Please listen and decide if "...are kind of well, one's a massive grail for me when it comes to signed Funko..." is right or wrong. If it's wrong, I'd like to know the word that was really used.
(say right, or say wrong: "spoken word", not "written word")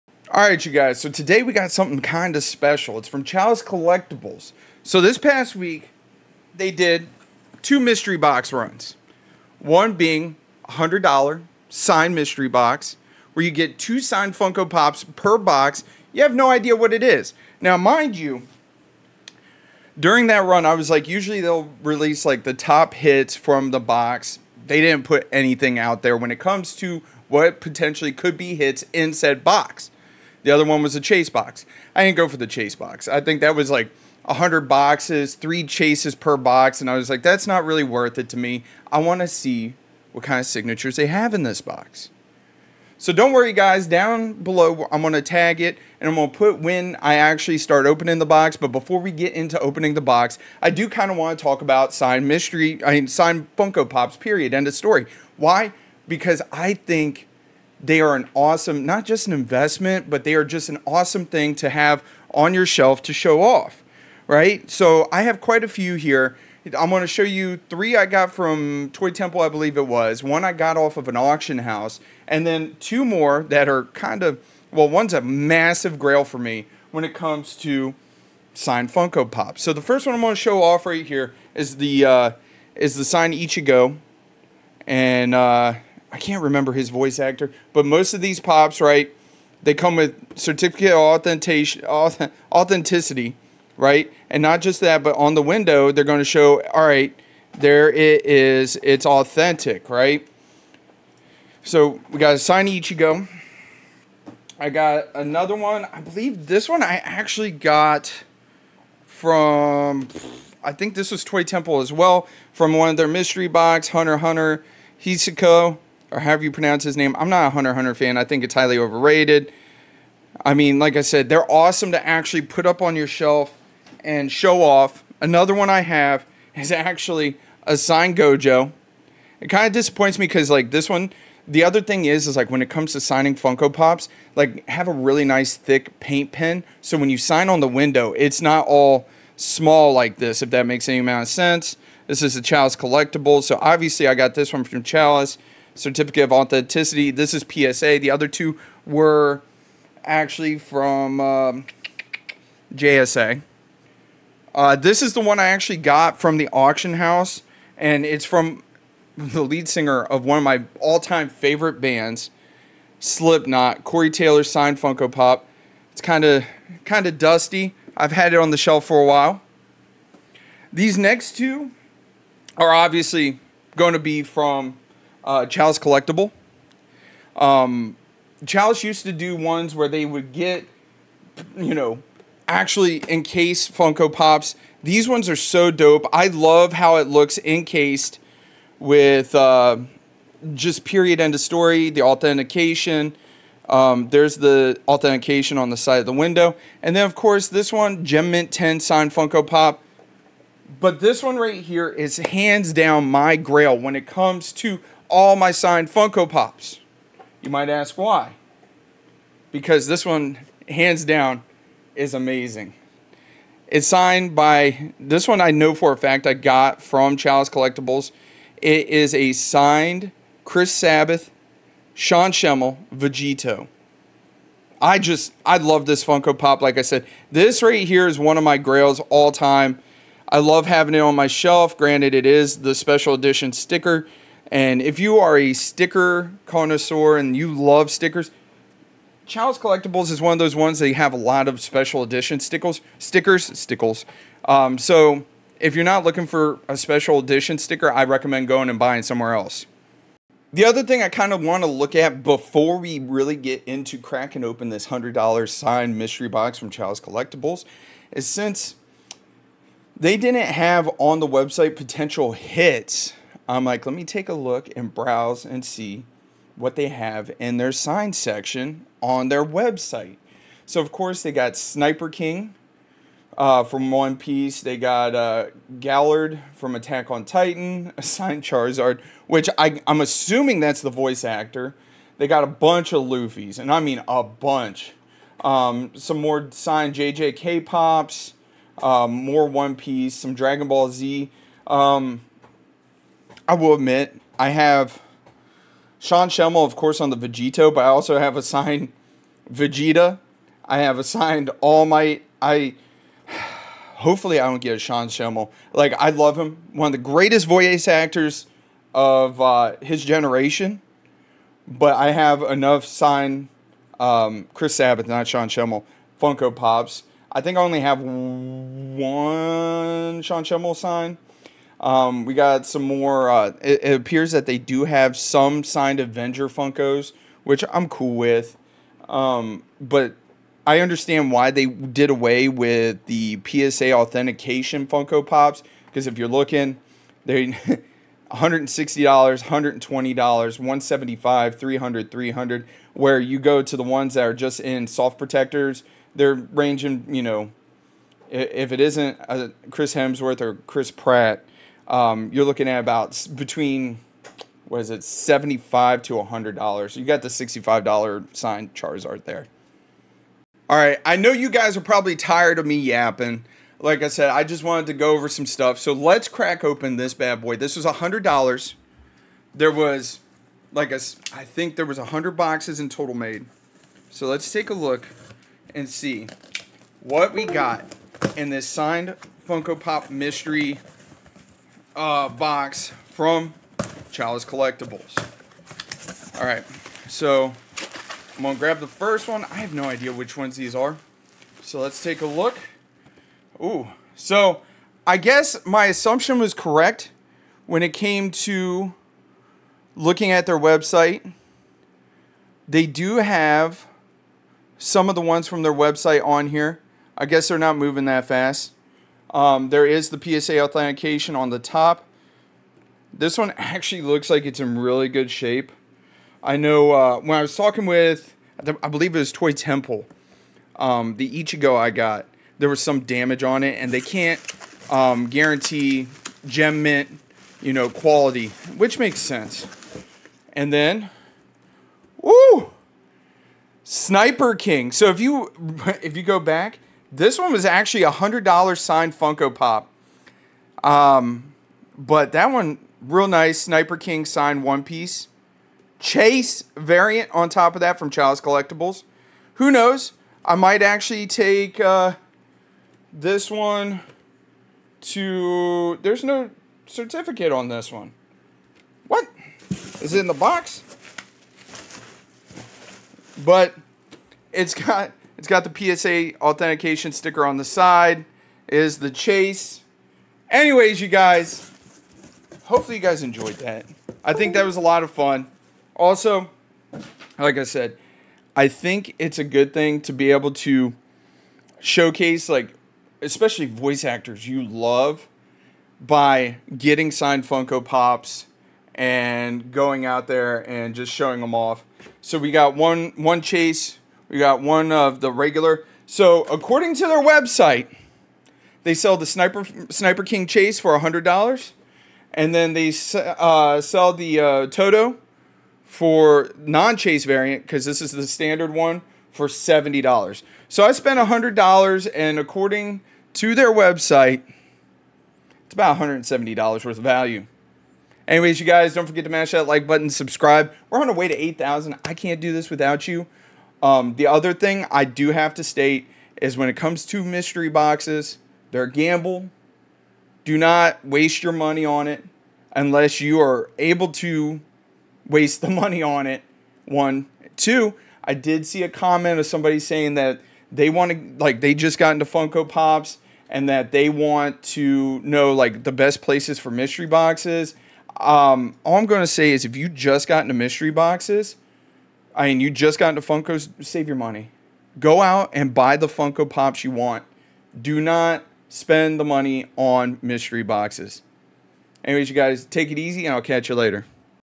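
right.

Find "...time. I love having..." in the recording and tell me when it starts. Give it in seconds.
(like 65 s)
229 s.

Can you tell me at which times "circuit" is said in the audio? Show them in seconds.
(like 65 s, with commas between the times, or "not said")
not said.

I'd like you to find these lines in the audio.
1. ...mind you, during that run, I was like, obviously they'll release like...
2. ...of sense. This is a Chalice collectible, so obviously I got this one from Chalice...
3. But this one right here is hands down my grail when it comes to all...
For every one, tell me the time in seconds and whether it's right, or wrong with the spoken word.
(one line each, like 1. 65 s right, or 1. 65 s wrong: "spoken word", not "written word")
1. 17 s wrong: "usually", not "obviously"
2. 141 s right
3. 200 s right.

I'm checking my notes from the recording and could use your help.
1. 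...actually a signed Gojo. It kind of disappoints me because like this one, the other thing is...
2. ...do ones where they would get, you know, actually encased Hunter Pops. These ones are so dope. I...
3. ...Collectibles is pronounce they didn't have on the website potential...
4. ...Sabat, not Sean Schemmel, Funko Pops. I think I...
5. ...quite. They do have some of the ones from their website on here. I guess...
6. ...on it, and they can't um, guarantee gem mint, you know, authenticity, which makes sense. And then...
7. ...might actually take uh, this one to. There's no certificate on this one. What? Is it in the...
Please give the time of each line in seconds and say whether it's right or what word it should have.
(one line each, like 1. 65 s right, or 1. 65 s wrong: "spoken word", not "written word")
1. 126 s right
2. 179 s wrong: "Funko", not "Hunter"
3. 256 s wrong: "since", not "pronounce"
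4. 314 s right
5. 400 s wrong: "website", not "quite"
6. 423 s wrong: "quality", not "authenticity"
7. 450 s right.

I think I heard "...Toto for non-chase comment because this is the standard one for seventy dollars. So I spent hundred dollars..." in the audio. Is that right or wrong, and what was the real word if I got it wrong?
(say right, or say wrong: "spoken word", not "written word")
wrong: "variant", not "comment".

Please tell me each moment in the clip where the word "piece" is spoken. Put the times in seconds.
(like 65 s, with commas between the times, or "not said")
274 s, 289 s, 444 s.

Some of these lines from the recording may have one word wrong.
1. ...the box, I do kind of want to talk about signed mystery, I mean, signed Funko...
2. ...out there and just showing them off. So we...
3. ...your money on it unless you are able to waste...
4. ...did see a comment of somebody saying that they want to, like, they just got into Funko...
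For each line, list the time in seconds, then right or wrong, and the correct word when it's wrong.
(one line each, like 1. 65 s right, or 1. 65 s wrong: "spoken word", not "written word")
1. 49 s right
2. 490 s right
3. 531 s right
4. 538 s right.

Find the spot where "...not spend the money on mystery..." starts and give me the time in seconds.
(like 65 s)
558 s.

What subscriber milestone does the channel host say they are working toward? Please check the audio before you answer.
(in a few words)
8,000.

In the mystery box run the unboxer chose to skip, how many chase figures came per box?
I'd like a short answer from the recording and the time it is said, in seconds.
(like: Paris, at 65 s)
3, at 35 s.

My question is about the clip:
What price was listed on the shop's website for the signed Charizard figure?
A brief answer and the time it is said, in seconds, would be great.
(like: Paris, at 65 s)
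$65, at 357 s.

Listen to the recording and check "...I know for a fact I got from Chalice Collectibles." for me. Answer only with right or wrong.
right.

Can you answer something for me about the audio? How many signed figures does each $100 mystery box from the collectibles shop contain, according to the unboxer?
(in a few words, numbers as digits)
2.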